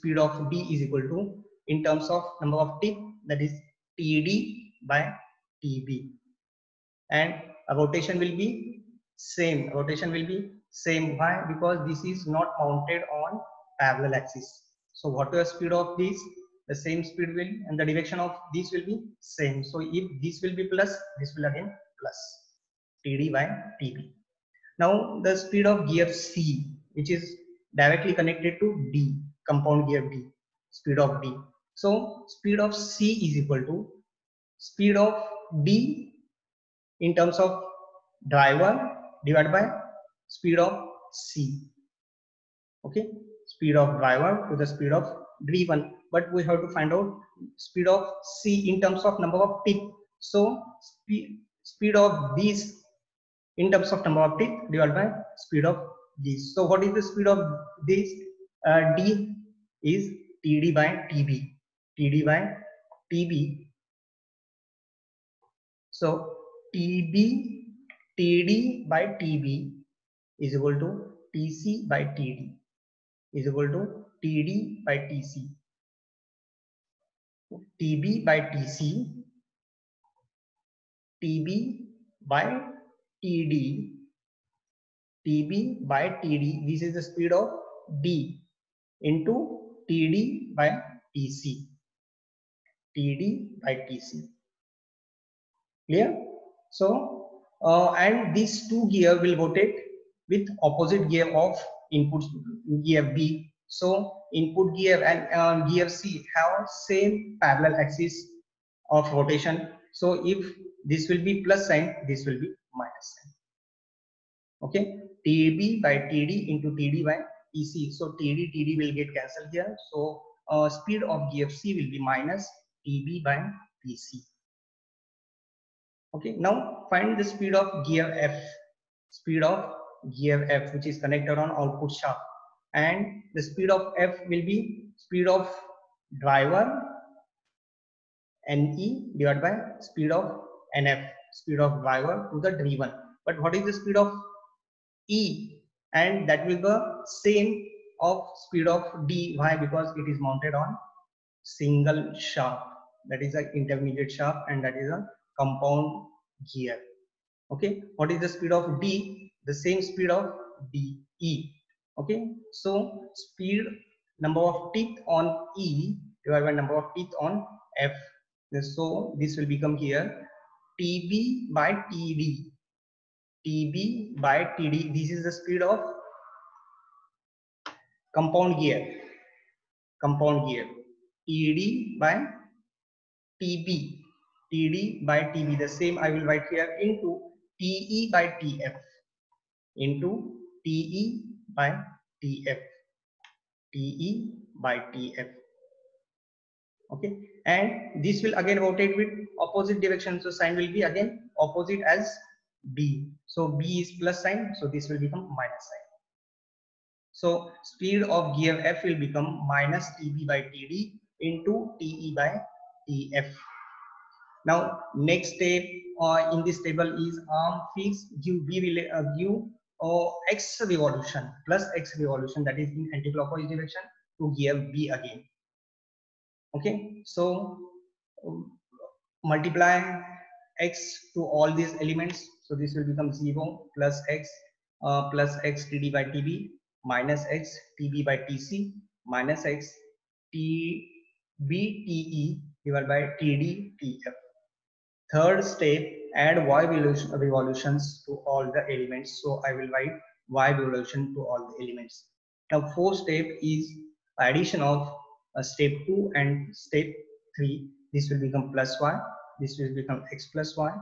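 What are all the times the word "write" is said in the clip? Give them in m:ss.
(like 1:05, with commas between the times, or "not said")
3:06, 4:09.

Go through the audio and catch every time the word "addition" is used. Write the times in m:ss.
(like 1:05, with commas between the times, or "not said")
4:14.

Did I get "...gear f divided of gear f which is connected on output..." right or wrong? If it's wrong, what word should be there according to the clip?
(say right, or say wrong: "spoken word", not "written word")
wrong: "speed", not "divided".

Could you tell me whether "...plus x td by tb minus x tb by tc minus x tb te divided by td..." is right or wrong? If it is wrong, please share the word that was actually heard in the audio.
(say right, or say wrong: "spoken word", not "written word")
right.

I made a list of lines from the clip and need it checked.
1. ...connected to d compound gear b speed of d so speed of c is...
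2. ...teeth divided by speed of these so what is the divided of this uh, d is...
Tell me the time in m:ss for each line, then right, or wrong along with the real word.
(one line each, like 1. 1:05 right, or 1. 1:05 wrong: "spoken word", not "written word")
1. 0:28 right
2. 0:54 wrong: "speed", not "divided".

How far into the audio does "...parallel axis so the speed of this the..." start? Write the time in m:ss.
0:13.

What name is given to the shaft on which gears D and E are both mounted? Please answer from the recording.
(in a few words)
intermediate shaft.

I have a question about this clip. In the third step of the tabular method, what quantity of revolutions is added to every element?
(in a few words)
y revolutions.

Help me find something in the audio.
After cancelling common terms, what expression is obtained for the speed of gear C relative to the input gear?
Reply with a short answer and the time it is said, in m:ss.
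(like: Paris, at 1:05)
minus TB by TC, at 2:01.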